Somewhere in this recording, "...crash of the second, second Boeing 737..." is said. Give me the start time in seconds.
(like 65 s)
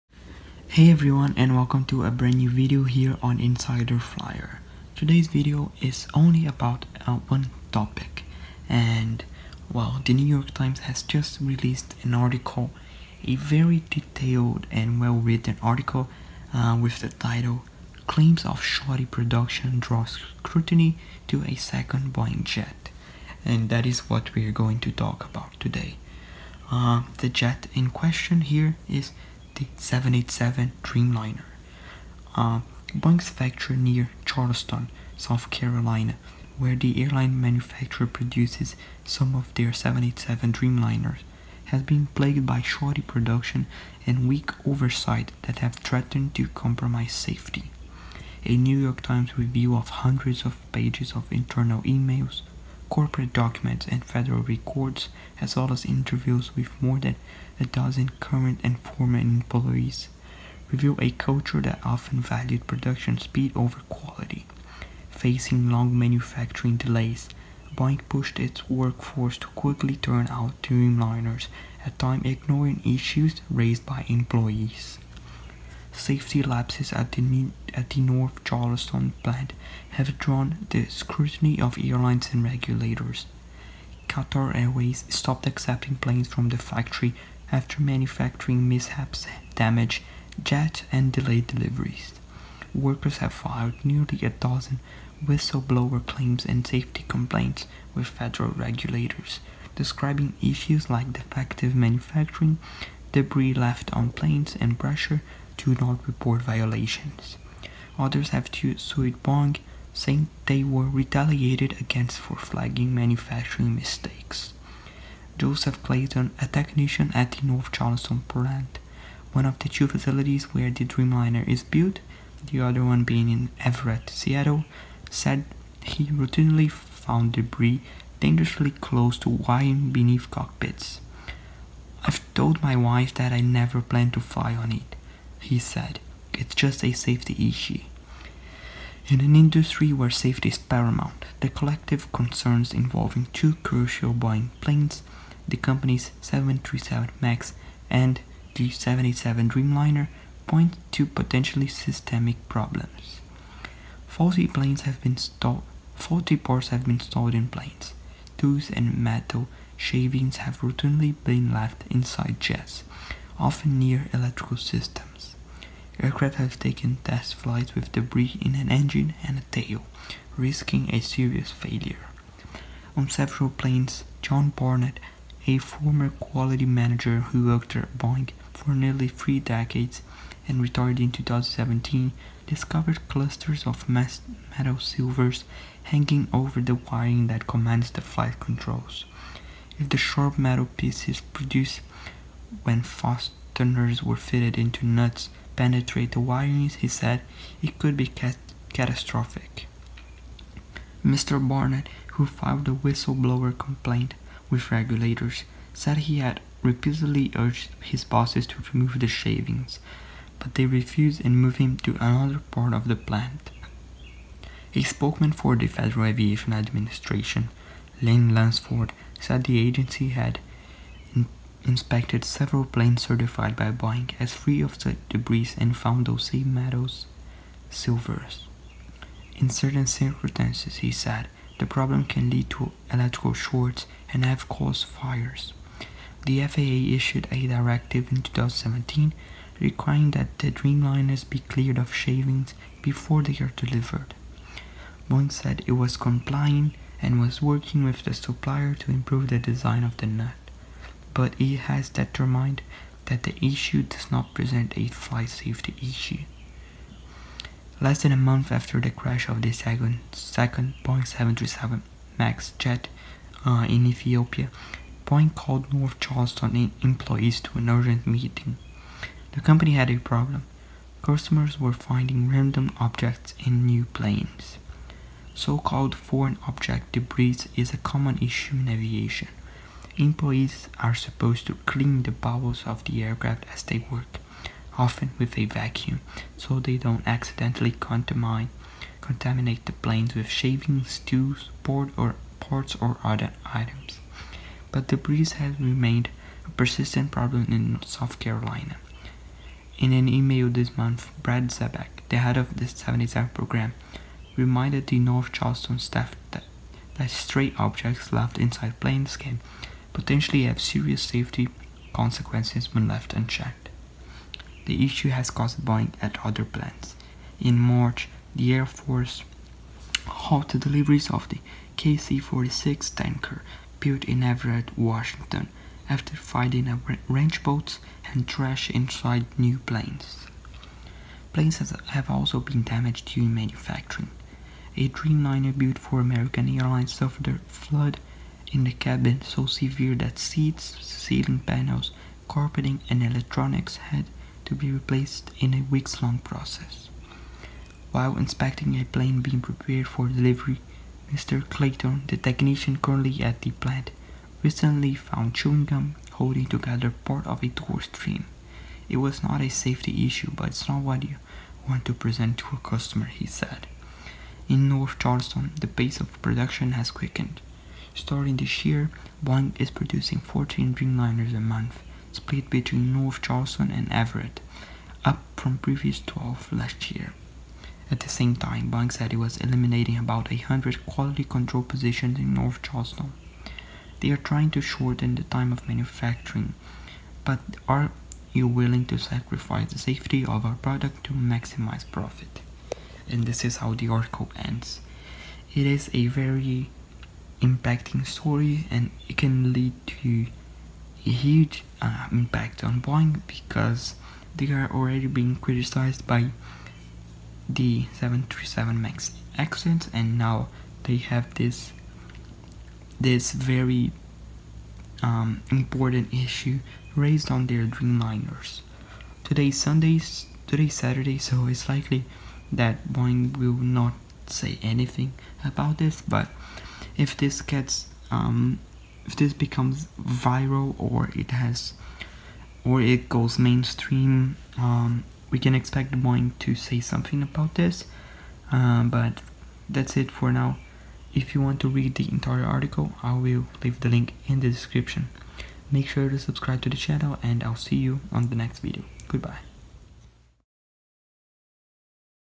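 258 s.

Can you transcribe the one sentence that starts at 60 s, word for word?
Reveal a culture that often valued production speed over quality.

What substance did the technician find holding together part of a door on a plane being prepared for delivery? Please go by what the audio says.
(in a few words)
Chewing gum.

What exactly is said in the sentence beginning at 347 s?
While inspecting a plane being prepared for delivery, Mr.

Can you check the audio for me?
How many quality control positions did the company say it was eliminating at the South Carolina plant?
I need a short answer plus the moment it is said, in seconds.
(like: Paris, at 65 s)
100, at 379 s.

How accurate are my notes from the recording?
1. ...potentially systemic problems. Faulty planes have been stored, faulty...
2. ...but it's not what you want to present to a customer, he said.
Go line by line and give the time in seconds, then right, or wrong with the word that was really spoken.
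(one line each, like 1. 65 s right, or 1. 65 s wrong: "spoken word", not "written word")
1. 151 s wrong: "stalled", not "stored"
2. 360 s right.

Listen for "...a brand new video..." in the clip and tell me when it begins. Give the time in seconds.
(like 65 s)
2 s.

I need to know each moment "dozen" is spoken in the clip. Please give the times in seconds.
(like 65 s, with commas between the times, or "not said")
57 s, 94 s.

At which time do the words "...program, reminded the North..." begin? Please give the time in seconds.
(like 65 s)
303 s.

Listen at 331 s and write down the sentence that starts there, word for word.
Planes have also been damaged during manufacturing.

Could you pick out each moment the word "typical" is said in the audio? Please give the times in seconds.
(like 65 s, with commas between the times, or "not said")
not said.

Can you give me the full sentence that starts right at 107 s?
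Others have to sued Boeing, saying they were retaliated against for flagging manufacturing mistakes.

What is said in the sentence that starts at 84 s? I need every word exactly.
Qatar Airways stopped accepting planes from the factory after manufacturing mishaps damaged jets and delayed deliveries.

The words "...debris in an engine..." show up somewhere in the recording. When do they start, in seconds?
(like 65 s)
167 s.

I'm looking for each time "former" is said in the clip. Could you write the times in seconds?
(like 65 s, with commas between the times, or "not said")
58 s, 175 s.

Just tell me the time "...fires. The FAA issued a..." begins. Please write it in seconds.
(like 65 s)
234 s.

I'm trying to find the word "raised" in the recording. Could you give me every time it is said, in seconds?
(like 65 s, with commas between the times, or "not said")
73 s, 416 s.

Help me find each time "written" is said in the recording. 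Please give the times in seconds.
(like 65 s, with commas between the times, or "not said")
15 s.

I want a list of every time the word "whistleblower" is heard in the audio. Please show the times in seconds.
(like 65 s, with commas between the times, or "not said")
95 s, 202 s.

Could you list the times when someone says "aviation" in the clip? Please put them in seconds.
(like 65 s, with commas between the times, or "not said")
216 s, 278 s.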